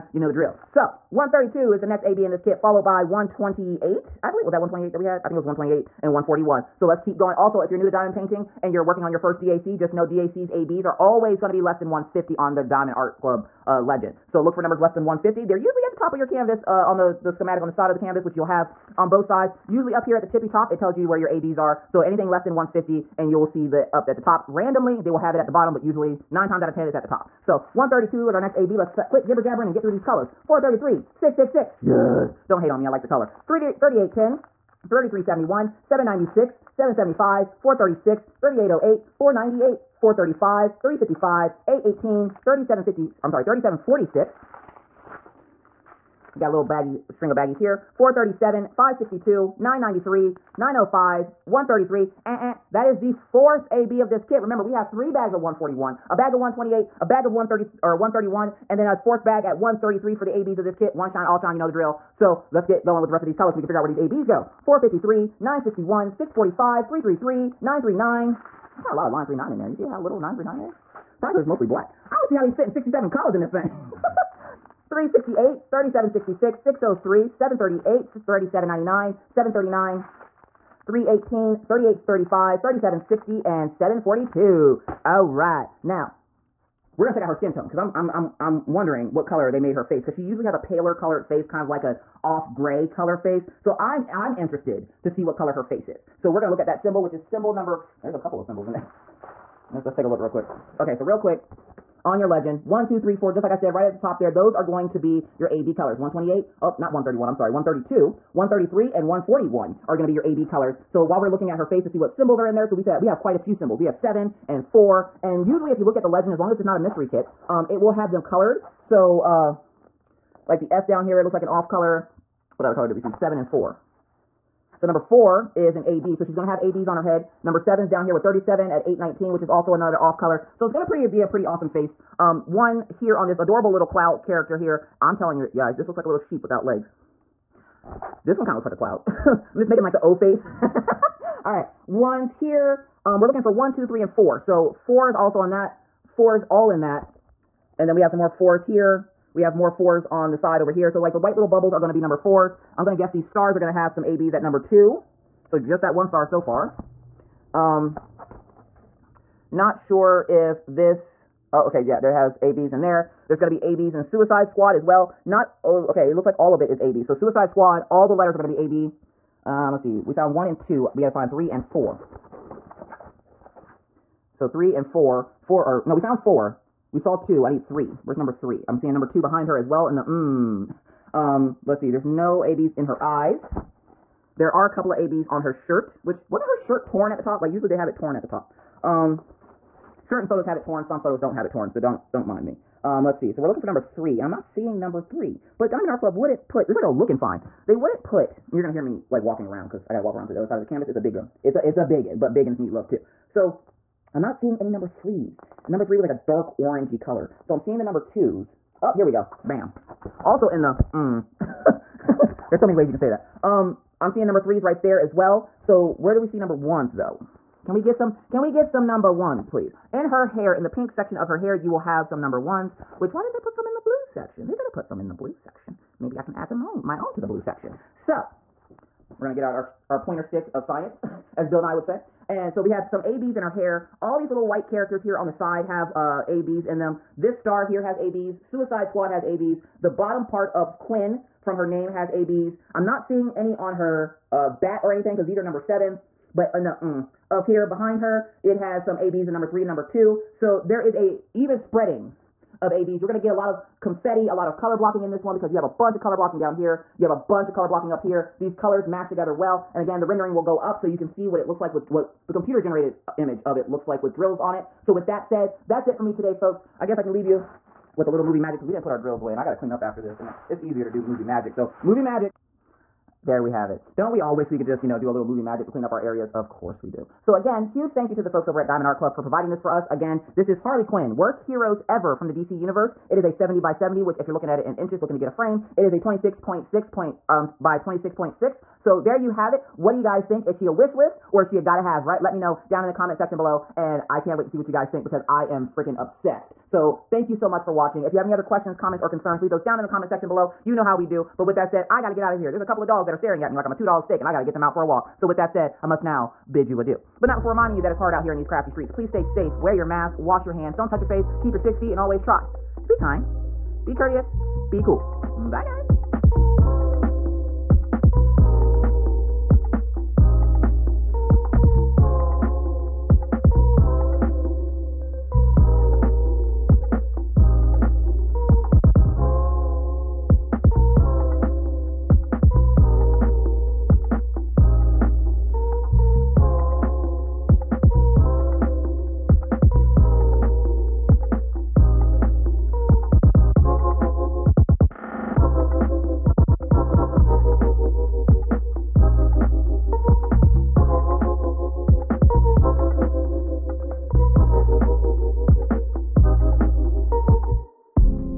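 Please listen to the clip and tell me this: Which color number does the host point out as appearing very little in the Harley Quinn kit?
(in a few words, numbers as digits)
939.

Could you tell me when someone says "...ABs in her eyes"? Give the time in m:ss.
3:02.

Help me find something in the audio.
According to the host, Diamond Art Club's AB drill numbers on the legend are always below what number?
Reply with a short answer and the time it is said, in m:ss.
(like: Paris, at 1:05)
150, at 0:11.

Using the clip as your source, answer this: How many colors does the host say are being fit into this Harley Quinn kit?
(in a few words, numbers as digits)
67.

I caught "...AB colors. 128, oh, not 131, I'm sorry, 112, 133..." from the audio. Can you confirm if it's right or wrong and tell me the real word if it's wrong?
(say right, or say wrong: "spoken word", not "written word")
wrong: "132", not "112".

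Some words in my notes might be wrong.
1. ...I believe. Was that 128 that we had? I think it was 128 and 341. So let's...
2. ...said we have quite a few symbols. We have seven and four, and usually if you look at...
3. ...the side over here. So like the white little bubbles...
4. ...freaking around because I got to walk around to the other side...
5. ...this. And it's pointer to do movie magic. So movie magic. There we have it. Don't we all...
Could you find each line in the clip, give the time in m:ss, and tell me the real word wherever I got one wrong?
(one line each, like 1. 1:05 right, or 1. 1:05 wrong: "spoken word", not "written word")
1. 0:04 wrong: "141", not "341"
2. 1:52 right
3. 2:30 right
4. 3:19 wrong: "walking", not "freaking"
5. 4:30 wrong: "easier", not "pointer".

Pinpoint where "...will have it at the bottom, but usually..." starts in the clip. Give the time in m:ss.
0:25.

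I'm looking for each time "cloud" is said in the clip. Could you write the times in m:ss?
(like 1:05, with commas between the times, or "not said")
2:13, 2:18.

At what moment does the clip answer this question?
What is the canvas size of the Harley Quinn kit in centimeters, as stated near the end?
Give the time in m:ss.
4:43.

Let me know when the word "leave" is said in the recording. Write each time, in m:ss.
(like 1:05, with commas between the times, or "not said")
4:27, 4:59.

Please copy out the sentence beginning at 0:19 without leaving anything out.
Usually up here at the tippy top, it tells you where your ABs are.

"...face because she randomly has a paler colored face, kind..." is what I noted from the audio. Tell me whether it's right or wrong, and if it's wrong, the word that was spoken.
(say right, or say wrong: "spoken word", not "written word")
wrong: "usually", not "randomly".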